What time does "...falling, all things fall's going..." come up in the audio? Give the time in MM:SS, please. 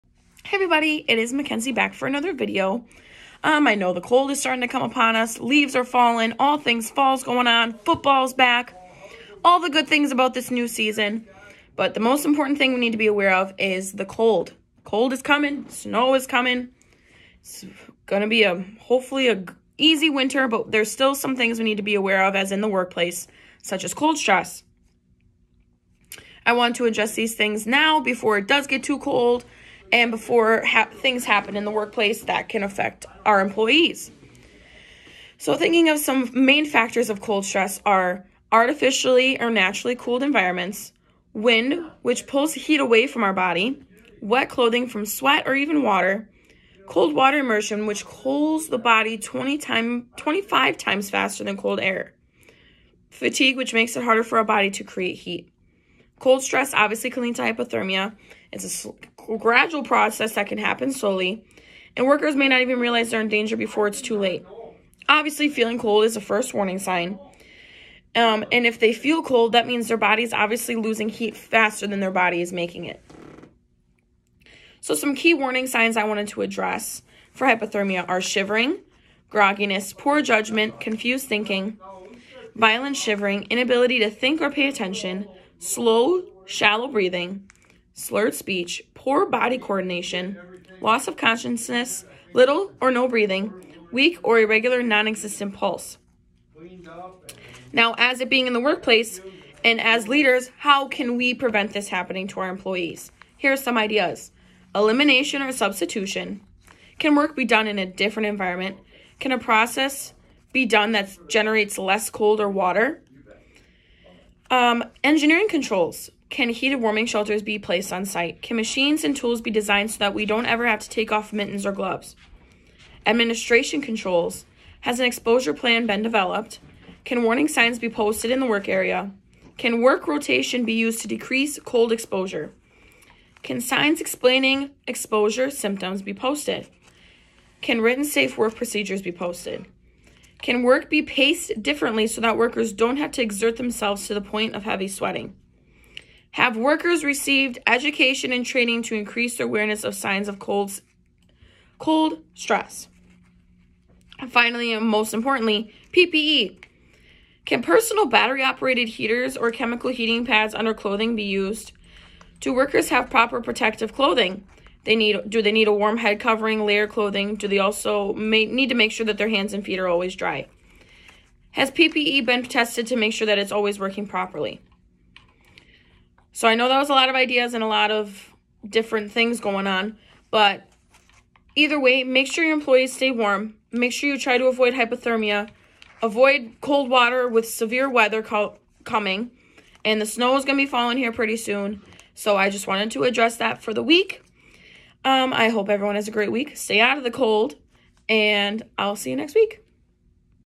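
00:05.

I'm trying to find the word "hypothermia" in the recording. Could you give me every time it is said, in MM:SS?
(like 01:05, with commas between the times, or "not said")
00:57, 01:17, 03:04.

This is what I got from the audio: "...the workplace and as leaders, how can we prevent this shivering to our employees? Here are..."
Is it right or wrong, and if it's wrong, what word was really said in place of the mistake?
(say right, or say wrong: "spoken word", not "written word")
wrong: "happening", not "shivering".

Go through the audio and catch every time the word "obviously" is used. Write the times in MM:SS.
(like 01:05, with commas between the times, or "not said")
00:56, 01:05, 01:10.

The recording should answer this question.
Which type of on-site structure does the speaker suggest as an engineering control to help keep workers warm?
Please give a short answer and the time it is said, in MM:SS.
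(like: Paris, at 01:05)
Heated warming shelters, at 01:56.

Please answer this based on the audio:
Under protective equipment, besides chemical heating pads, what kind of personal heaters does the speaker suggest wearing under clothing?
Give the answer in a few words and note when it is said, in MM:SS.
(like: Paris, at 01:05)
Battery operated heaters, at 02:38.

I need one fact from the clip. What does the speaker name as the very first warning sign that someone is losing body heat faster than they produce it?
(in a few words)
Feeling cold.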